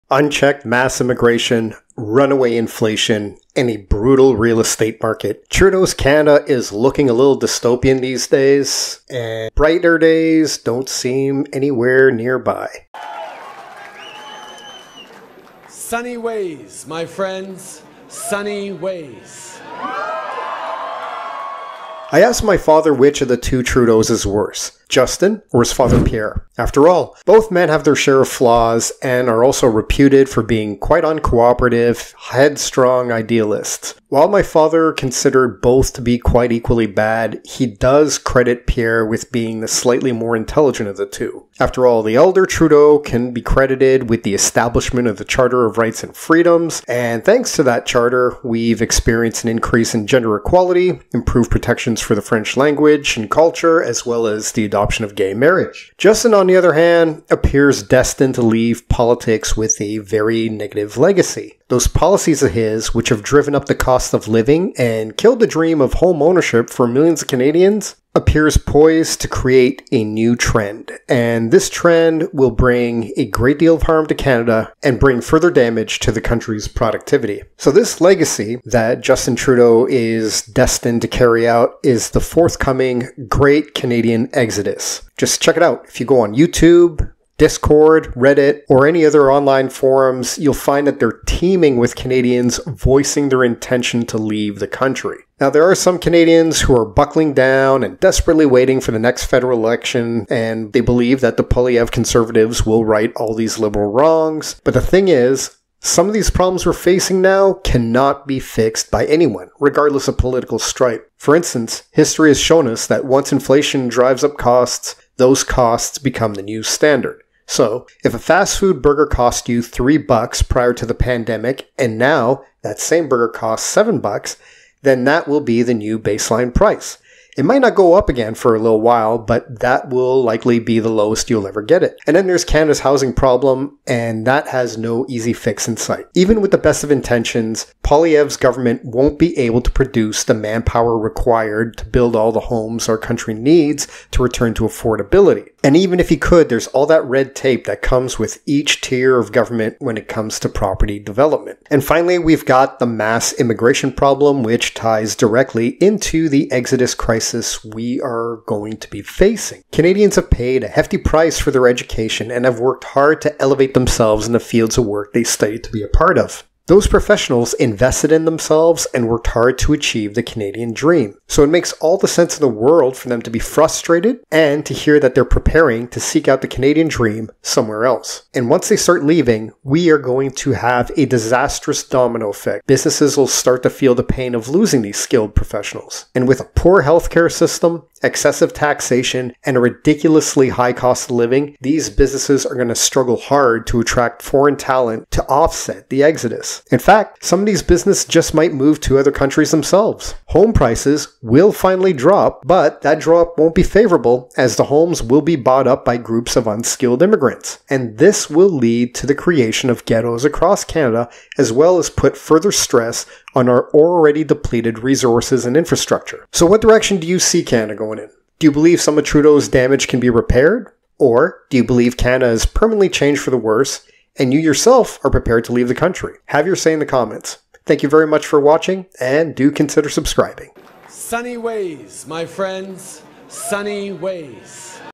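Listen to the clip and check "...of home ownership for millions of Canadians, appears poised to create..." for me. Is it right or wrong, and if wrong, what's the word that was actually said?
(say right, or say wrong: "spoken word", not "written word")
right.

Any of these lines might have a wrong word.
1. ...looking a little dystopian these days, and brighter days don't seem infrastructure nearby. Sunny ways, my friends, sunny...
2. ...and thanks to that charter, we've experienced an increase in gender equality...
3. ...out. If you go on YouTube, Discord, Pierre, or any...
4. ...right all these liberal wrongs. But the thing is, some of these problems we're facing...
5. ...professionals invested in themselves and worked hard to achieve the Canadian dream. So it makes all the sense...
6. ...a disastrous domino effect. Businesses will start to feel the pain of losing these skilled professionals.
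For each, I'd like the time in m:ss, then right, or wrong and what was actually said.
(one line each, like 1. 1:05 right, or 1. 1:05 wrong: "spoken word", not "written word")
1. 0:06 wrong: "anywhere", not "infrastructure"
2. 0:46 right
3. 1:25 wrong: "Reddit", not "Pierre"
4. 1:42 right
5. 2:46 right
6. 3:00 right.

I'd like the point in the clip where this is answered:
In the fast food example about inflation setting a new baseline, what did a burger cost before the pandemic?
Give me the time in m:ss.
1:59.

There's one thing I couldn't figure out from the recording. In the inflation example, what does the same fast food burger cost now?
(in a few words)
$7.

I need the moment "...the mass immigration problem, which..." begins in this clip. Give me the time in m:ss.
2:32.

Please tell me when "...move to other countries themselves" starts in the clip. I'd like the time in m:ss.
3:18.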